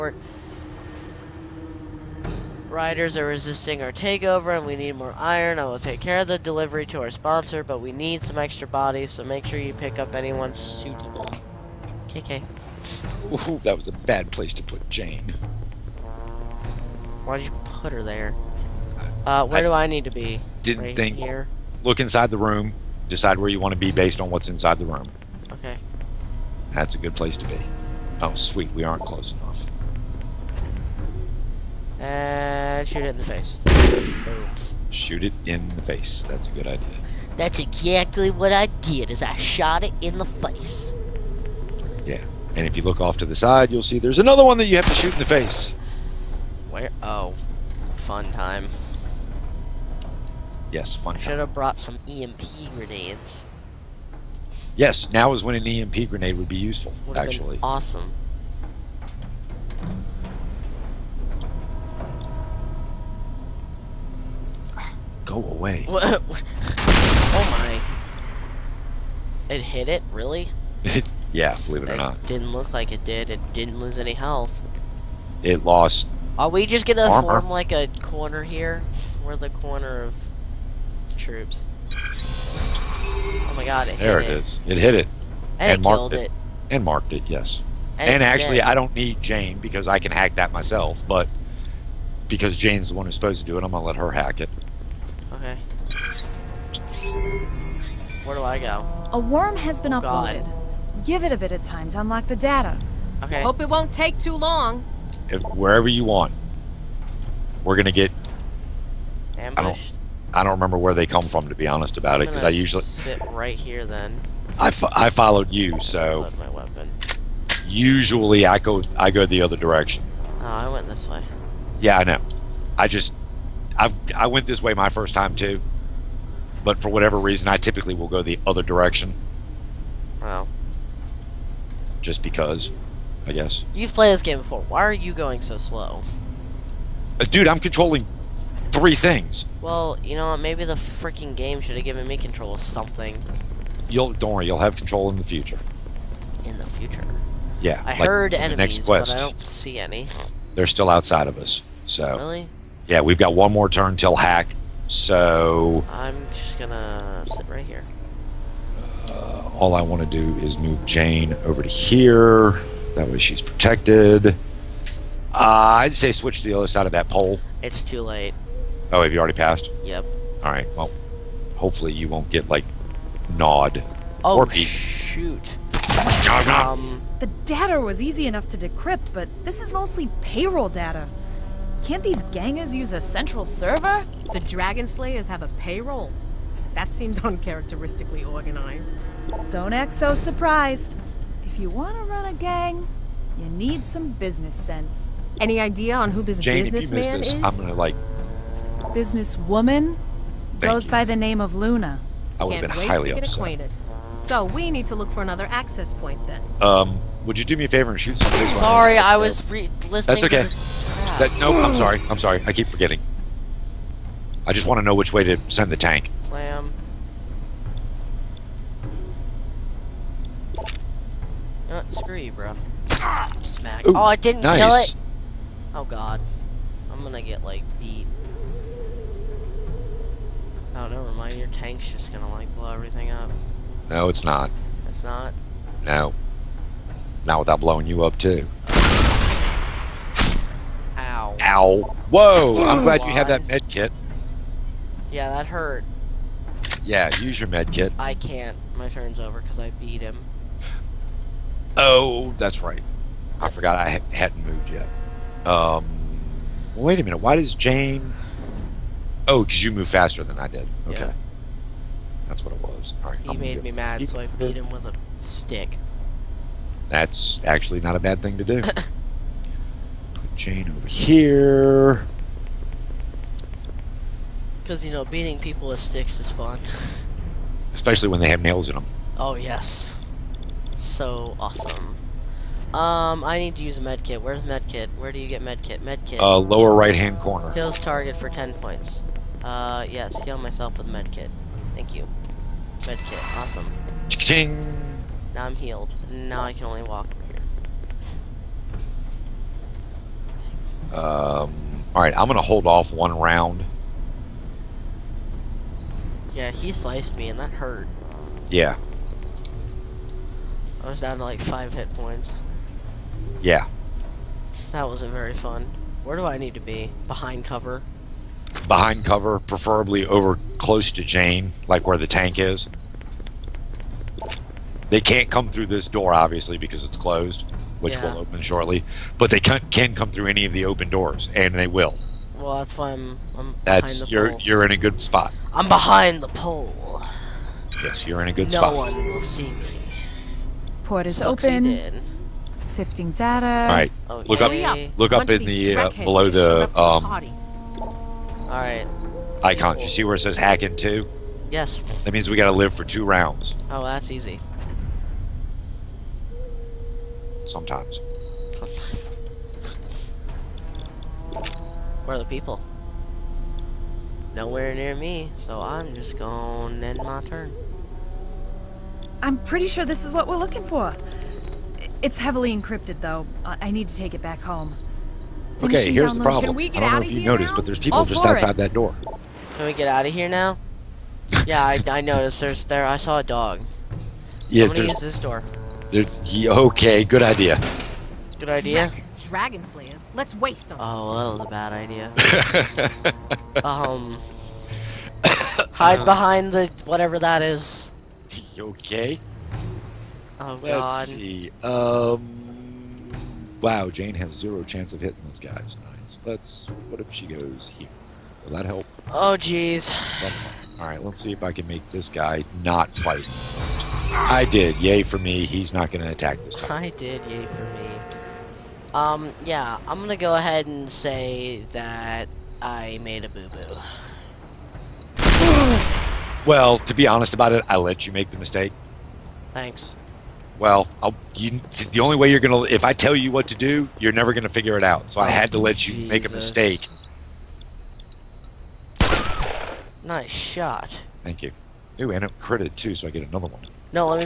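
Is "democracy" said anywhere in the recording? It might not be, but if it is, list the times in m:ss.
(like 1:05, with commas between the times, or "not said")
not said.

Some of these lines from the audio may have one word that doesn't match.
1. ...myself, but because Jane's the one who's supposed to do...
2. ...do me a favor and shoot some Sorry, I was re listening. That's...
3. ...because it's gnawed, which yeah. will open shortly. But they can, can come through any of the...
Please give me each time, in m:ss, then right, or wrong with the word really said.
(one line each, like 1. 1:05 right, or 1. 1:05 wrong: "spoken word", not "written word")
1. 1:30 right
2. 3:27 right
3. 5:26 wrong: "closed", not "gnawed".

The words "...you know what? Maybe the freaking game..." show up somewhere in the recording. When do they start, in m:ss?
2:20.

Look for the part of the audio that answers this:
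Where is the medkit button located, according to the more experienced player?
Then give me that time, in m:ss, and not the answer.
4:46.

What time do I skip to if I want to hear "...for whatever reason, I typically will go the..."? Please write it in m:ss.
2:06.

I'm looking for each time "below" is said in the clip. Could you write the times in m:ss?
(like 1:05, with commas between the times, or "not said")
5:45.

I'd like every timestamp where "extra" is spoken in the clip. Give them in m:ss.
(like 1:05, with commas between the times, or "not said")
0:08.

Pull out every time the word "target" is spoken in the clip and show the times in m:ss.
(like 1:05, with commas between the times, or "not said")
4:47.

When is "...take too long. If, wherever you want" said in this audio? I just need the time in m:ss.
1:43.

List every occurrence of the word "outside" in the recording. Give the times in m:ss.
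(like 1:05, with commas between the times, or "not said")
2:30, 6:18.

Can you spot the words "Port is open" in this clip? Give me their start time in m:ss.
5:40.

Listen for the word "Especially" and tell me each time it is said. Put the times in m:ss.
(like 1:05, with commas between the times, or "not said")
4:37.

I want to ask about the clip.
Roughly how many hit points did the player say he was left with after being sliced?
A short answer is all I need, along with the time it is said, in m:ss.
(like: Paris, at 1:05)
5, at 5:11.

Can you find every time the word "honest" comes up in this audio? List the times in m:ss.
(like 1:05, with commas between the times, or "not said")
1:51, 7:07.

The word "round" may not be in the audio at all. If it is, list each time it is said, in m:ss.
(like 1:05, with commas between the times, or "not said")
5:03, 5:53.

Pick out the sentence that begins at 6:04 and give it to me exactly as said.
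Nowhere near me, so I'm just going to end my turn.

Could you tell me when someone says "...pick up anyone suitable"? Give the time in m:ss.
0:09.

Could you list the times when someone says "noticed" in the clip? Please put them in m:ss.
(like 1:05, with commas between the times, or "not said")
6:17, 6:22.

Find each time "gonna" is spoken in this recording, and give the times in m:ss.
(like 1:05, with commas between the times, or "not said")
1:16, 2:36, 3:17, 3:47, 3:52, 5:02.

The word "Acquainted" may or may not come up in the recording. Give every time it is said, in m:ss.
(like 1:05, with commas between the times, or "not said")
3:23.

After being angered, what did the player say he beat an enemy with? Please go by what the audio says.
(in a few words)
a stick.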